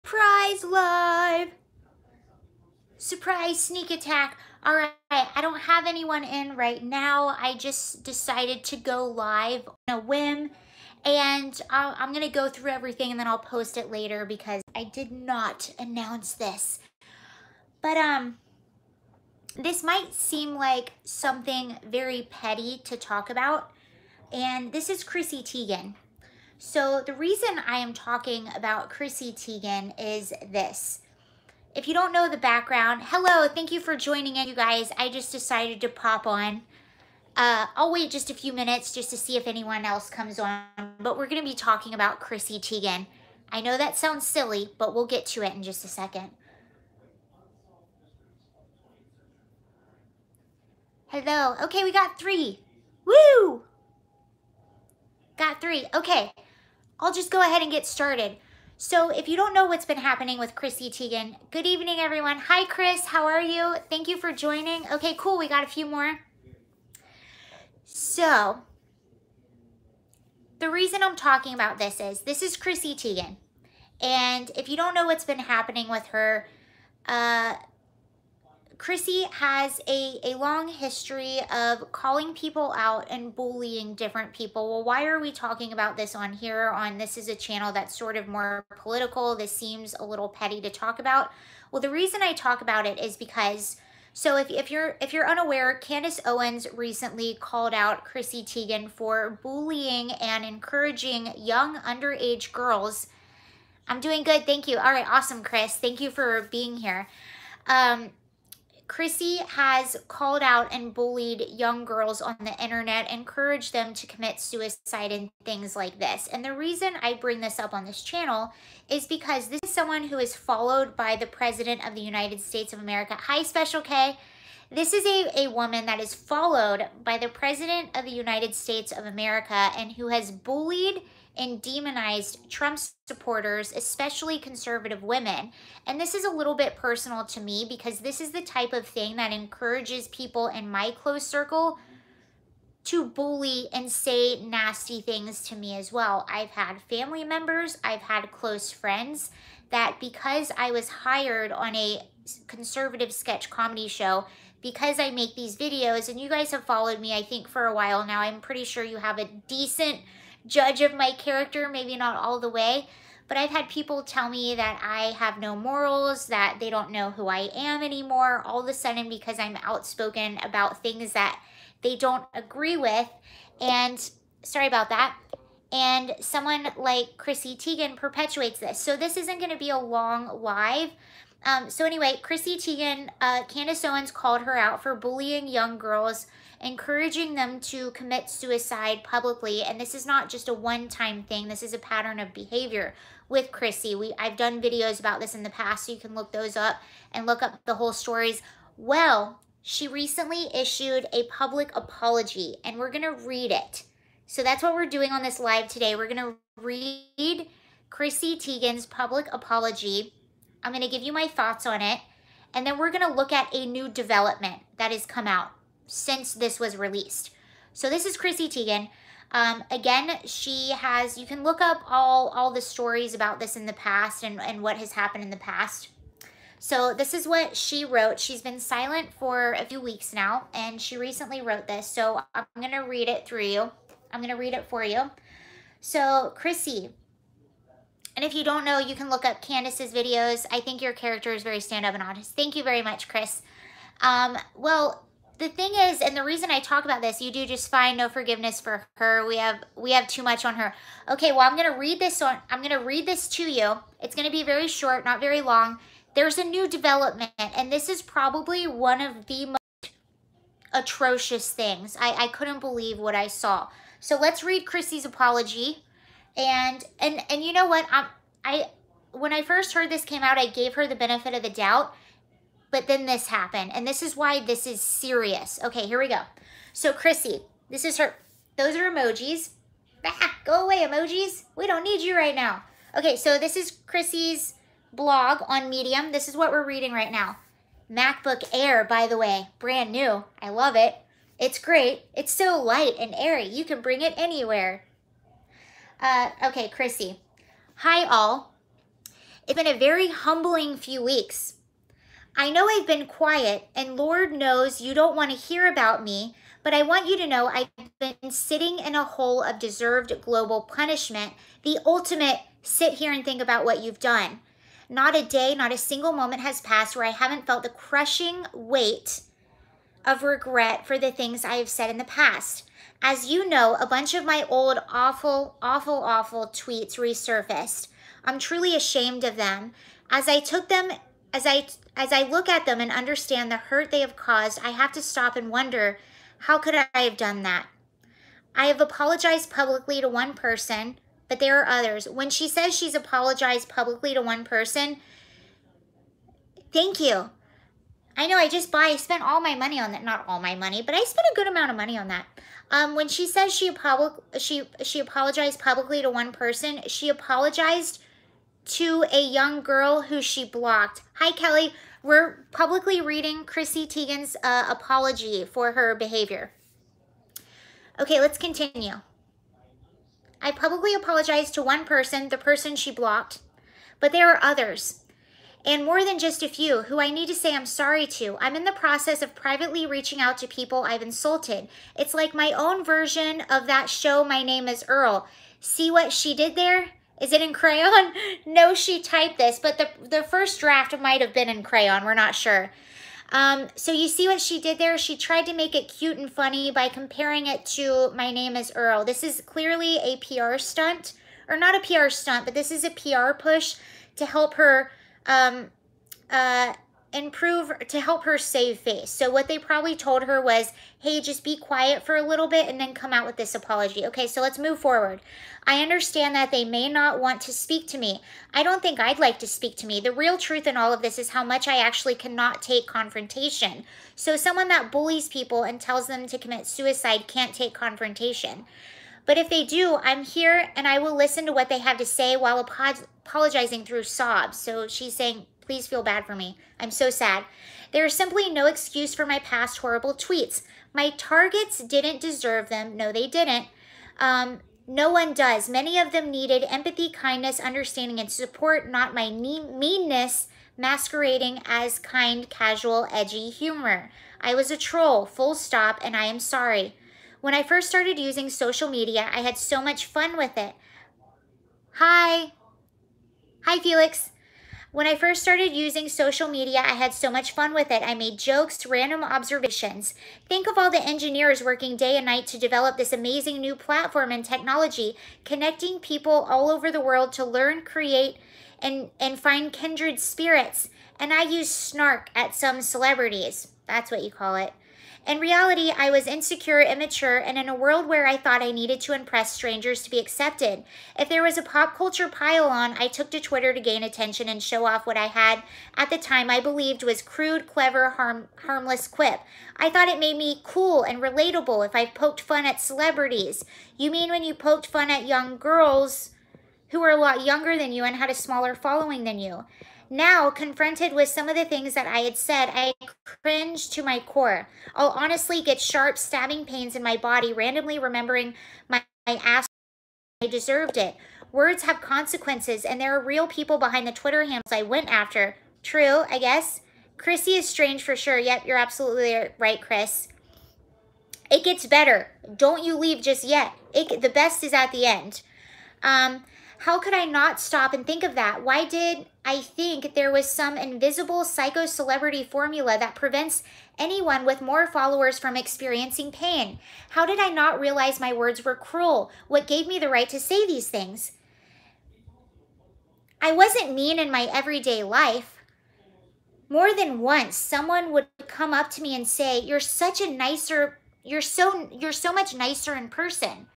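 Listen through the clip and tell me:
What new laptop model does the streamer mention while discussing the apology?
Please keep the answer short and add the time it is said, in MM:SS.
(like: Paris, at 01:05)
MacBook Air, at 04:47.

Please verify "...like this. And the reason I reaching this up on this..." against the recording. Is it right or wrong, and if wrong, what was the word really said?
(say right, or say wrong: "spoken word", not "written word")
wrong: "bring", not "reaching".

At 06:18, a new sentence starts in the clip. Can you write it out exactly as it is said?
I'm in the process of privately reaching out to people I've insulted.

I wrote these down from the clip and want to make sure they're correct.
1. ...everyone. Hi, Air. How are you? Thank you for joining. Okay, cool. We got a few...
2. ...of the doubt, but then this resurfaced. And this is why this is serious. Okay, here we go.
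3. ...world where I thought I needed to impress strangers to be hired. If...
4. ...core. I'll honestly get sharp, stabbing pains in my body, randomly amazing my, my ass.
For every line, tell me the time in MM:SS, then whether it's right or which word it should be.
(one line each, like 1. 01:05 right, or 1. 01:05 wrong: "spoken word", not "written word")
1. 01:01 wrong: "Chris", not "Air"
2. 04:31 wrong: "happened", not "resurfaced"
3. 08:07 wrong: "accepted", not "hired"
4. 08:34 wrong: "remembering", not "amazing".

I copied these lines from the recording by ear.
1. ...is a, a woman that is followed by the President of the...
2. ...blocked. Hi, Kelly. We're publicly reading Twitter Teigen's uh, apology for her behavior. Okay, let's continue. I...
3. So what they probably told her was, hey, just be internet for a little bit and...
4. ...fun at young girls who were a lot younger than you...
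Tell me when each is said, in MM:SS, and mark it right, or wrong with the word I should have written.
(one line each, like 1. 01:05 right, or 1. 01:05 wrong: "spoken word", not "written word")
1. 02:04 right
2. 06:00 wrong: "Chrissy", not "Twitter"
3. 06:49 wrong: "quiet", not "internet"
4. 08:24 right.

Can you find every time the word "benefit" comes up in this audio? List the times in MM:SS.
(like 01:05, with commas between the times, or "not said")
04:30.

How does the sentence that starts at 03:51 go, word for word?
So I'm going to read it through you.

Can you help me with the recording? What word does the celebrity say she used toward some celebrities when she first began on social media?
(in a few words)
snark.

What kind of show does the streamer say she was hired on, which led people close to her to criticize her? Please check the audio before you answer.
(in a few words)
conservative sketch comedy show.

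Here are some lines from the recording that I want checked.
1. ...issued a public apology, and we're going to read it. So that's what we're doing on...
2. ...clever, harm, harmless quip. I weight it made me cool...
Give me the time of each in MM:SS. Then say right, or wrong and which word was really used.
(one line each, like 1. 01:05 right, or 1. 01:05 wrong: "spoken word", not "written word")
1. 03:20 right
2. 08:17 wrong: "thought", not "weight".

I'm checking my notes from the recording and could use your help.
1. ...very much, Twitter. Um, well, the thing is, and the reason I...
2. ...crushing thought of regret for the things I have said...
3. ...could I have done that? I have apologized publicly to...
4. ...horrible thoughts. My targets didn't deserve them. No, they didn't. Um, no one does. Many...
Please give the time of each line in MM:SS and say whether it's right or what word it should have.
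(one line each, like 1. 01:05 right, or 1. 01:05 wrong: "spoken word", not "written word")
1. 04:02 wrong: "Chris", not "Twitter"
2. 05:17 wrong: "weight", not "thought"
3. 05:36 right
4. 07:19 wrong: "tweets", not "thoughts".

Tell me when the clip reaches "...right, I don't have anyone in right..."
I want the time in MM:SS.
00:04.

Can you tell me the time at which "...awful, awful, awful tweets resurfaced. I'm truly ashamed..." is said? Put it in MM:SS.
05:24.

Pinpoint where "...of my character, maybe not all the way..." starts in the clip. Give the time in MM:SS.
02:40.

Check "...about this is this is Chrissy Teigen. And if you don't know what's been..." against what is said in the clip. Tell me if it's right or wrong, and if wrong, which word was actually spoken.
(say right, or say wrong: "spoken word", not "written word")
right.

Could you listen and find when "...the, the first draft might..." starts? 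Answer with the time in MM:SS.
06:29.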